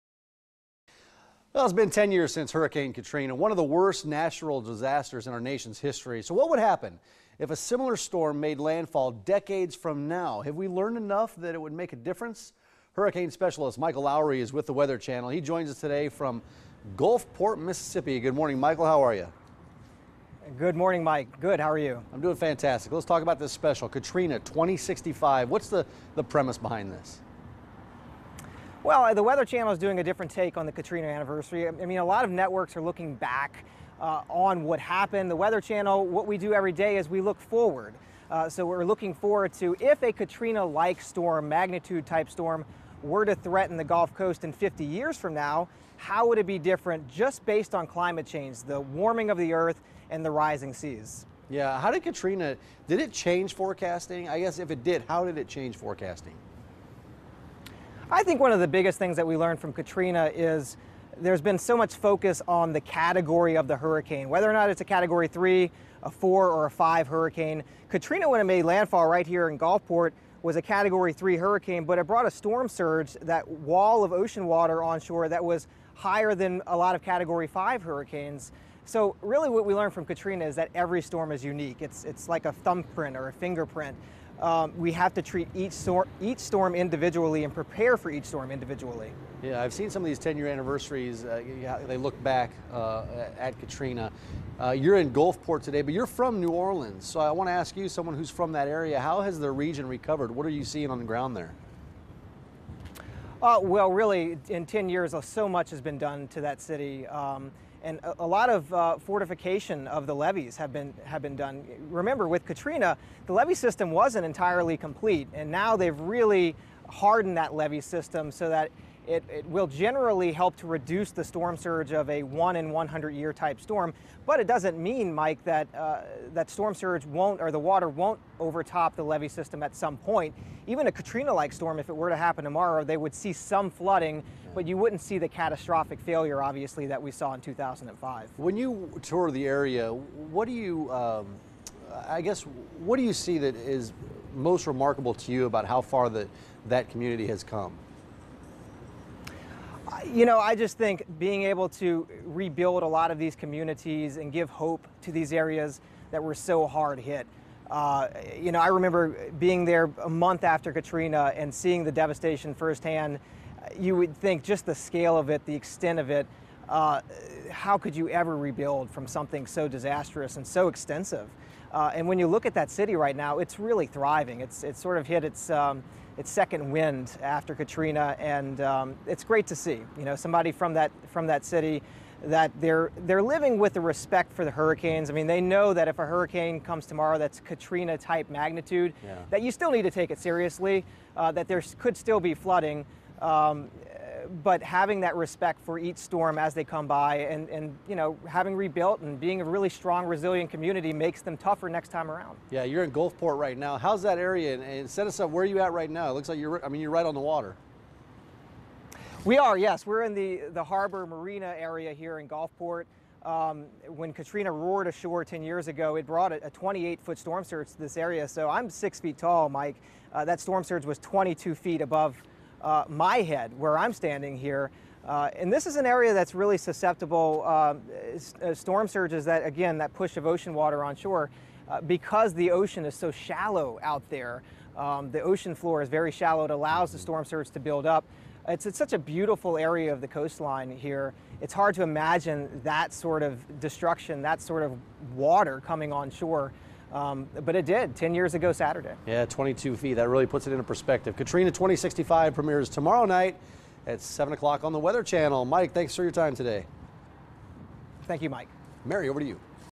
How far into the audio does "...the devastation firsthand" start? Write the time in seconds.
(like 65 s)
161 s.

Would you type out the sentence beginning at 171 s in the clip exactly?
Uh, and when you look at that city right now, it's really thriving.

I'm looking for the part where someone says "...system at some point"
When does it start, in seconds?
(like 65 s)
129 s.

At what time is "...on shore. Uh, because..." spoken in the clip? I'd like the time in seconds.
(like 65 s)
230 s.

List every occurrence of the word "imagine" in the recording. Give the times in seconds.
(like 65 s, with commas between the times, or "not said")
241 s.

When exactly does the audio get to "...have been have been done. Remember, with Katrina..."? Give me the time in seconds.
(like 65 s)
110 s.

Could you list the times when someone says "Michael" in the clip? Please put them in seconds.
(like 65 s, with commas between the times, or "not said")
13 s, 18 s.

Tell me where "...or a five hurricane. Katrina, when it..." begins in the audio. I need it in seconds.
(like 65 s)
66 s.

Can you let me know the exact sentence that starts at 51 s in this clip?
Yeah, how did Katrina, did it change forecasting?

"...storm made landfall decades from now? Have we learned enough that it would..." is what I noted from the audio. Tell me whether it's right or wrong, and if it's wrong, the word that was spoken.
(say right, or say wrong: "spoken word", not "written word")
right.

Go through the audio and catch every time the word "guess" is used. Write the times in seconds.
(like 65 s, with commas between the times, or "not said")
54 s, 142 s.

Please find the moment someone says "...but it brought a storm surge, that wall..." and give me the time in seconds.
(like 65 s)
71 s.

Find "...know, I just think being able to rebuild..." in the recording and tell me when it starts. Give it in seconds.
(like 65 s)
150 s.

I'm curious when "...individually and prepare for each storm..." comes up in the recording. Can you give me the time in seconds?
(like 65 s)
86 s.